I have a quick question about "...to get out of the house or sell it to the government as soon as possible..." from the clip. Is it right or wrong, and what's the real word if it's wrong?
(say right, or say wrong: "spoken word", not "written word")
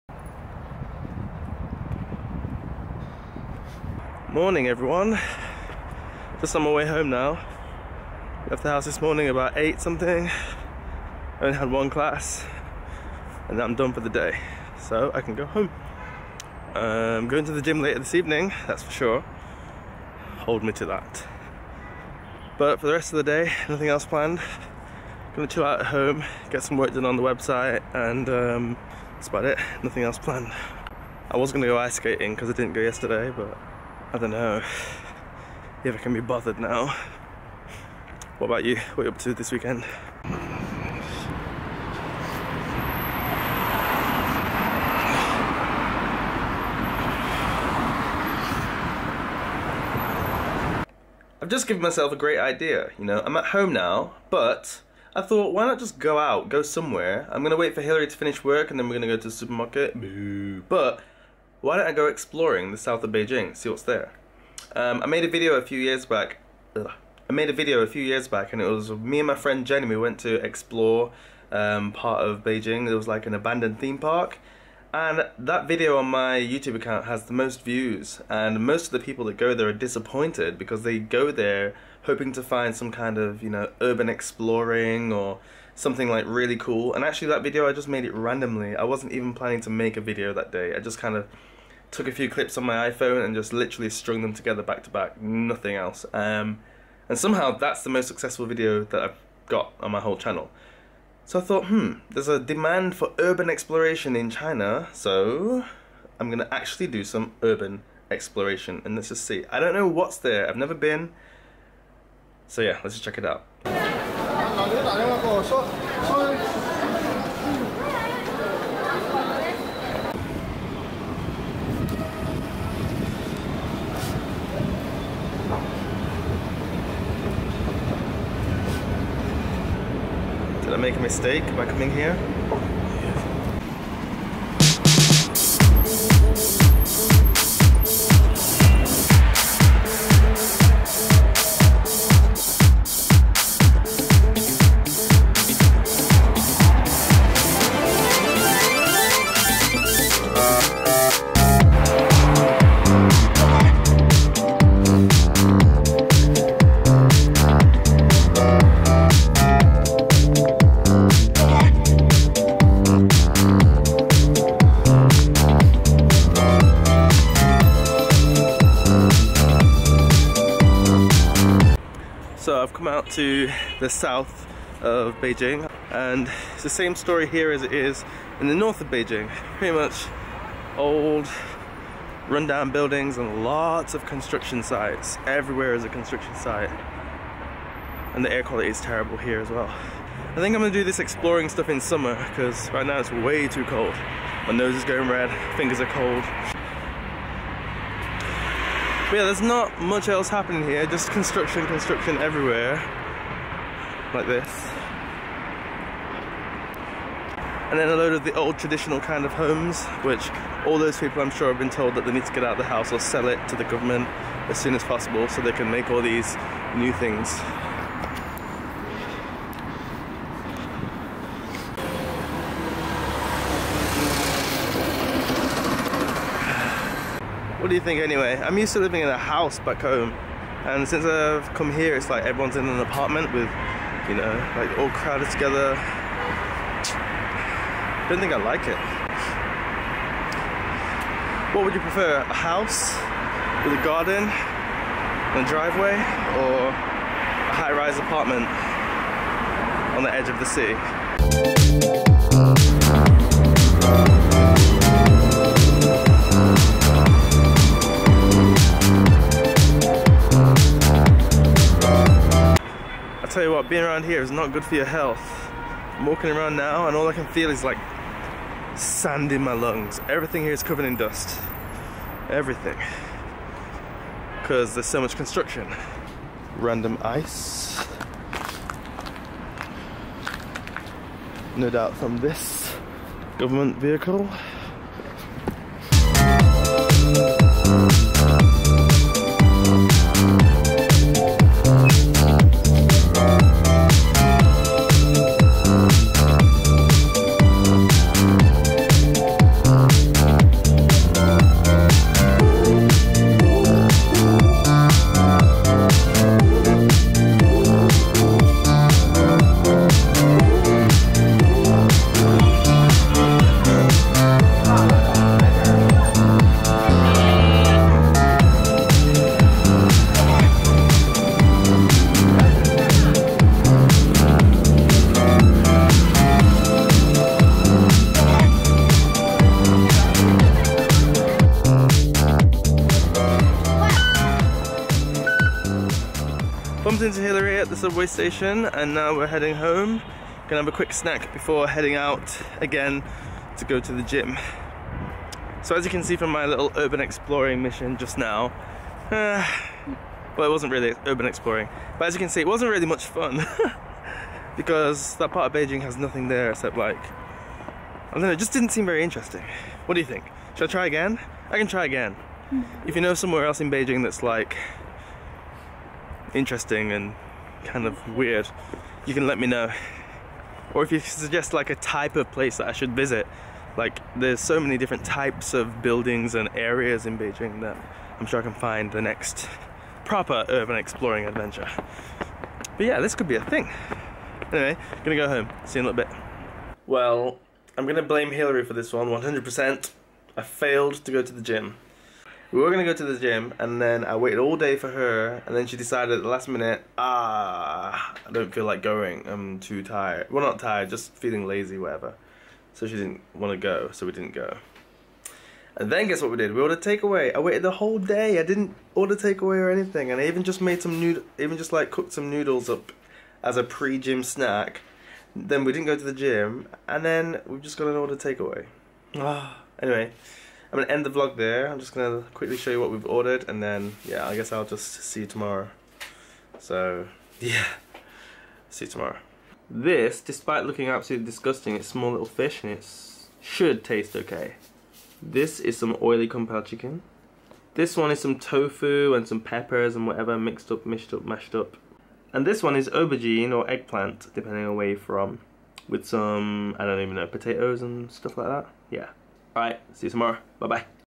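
right.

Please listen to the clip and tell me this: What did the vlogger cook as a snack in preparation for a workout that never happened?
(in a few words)
Noodles.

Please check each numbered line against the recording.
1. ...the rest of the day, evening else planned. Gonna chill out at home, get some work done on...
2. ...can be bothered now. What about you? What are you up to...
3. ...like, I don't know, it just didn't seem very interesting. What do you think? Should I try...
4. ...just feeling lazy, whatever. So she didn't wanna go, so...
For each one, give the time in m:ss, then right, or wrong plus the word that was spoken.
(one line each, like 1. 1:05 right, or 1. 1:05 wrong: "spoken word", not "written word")
1. 0:22 wrong: "nothing", not "evening"
2. 0:35 right
3. 5:56 right
4. 6:40 right.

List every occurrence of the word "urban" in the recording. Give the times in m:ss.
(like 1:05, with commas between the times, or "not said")
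1:23, 1:43, 1:47, 5:46, 5:51, 6:20.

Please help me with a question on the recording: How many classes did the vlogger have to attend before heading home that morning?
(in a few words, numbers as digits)
1.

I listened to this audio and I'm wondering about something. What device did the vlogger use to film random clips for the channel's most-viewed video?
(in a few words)
iPhone.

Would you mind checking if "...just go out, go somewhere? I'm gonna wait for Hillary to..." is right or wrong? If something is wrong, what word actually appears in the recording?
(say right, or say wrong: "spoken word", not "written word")
right.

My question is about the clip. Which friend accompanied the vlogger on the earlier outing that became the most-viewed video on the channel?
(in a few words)
Jenny.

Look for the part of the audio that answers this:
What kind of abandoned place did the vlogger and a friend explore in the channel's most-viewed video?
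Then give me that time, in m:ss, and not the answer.
1:13.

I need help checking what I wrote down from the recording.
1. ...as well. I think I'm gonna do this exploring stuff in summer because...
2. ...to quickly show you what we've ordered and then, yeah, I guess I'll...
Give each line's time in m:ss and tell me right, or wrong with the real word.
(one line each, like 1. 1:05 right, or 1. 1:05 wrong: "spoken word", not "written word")
1. 3:09 right
2. 7:02 right.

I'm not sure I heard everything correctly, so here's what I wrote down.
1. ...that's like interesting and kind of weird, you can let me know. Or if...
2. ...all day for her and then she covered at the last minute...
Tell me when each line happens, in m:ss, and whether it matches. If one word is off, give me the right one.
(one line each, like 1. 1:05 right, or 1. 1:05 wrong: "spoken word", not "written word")
1. 6:04 right
2. 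6:34 wrong: "decided", not "covered".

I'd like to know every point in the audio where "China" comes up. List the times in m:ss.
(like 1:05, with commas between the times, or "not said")
1:44.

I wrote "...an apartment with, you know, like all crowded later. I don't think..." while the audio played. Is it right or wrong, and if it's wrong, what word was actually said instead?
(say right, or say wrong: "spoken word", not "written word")
wrong: "together", not "later".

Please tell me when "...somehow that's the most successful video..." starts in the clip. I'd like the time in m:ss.
1:37.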